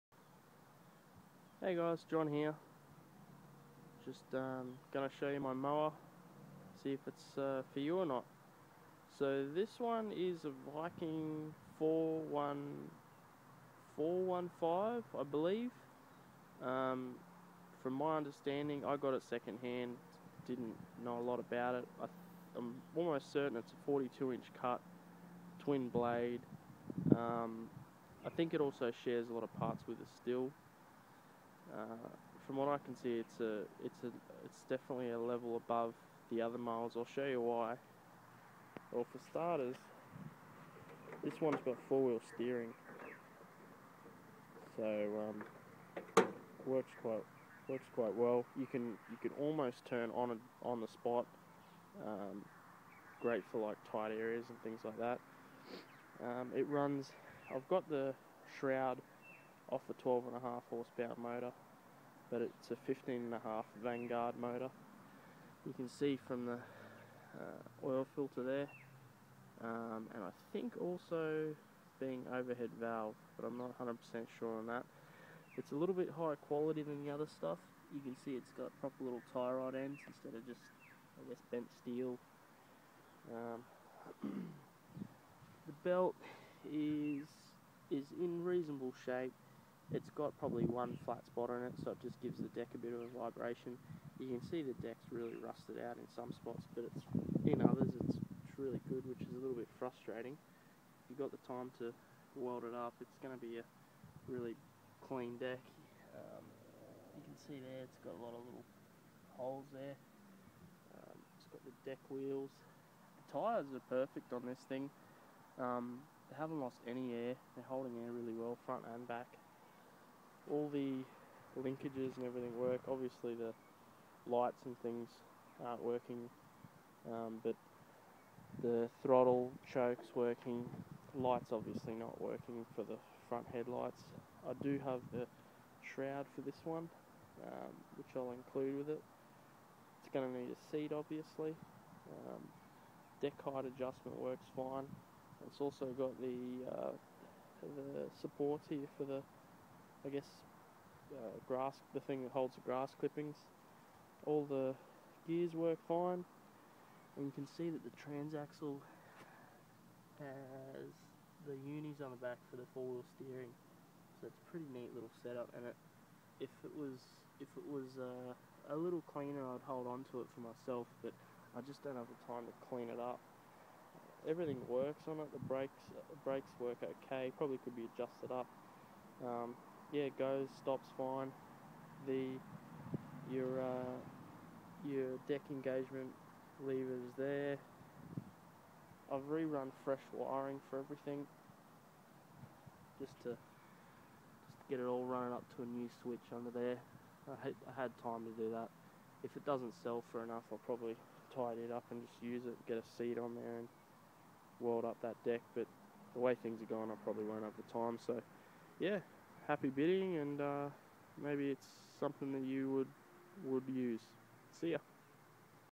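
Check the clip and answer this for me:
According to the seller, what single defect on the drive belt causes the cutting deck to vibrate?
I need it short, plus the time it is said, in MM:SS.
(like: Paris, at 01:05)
One flat spot, at 01:30.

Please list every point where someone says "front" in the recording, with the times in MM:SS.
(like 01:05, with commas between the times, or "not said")
01:58, 02:13.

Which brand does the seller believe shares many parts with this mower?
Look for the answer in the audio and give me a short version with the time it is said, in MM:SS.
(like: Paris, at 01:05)
Stihl, at 00:30.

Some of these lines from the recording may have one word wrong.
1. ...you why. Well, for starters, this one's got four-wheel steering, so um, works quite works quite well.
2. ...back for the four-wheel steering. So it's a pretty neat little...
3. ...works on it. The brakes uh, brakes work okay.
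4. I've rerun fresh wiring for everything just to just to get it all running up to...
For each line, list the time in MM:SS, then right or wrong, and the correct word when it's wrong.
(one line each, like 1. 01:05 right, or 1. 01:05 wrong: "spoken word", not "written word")
1. 00:37 right
2. 02:42 right
3. 02:54 right
4. 03:09 right.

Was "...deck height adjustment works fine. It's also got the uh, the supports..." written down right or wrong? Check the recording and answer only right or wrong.
right.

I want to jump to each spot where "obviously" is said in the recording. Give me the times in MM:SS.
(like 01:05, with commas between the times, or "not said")
02:02, 02:11, 02:20.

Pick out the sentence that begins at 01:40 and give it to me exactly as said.
If you've got the time to weld it up, it's going to be a really clean deck.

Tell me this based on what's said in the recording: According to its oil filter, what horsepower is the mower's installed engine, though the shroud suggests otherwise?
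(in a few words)
15.5.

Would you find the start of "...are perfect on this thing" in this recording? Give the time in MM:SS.
01:53.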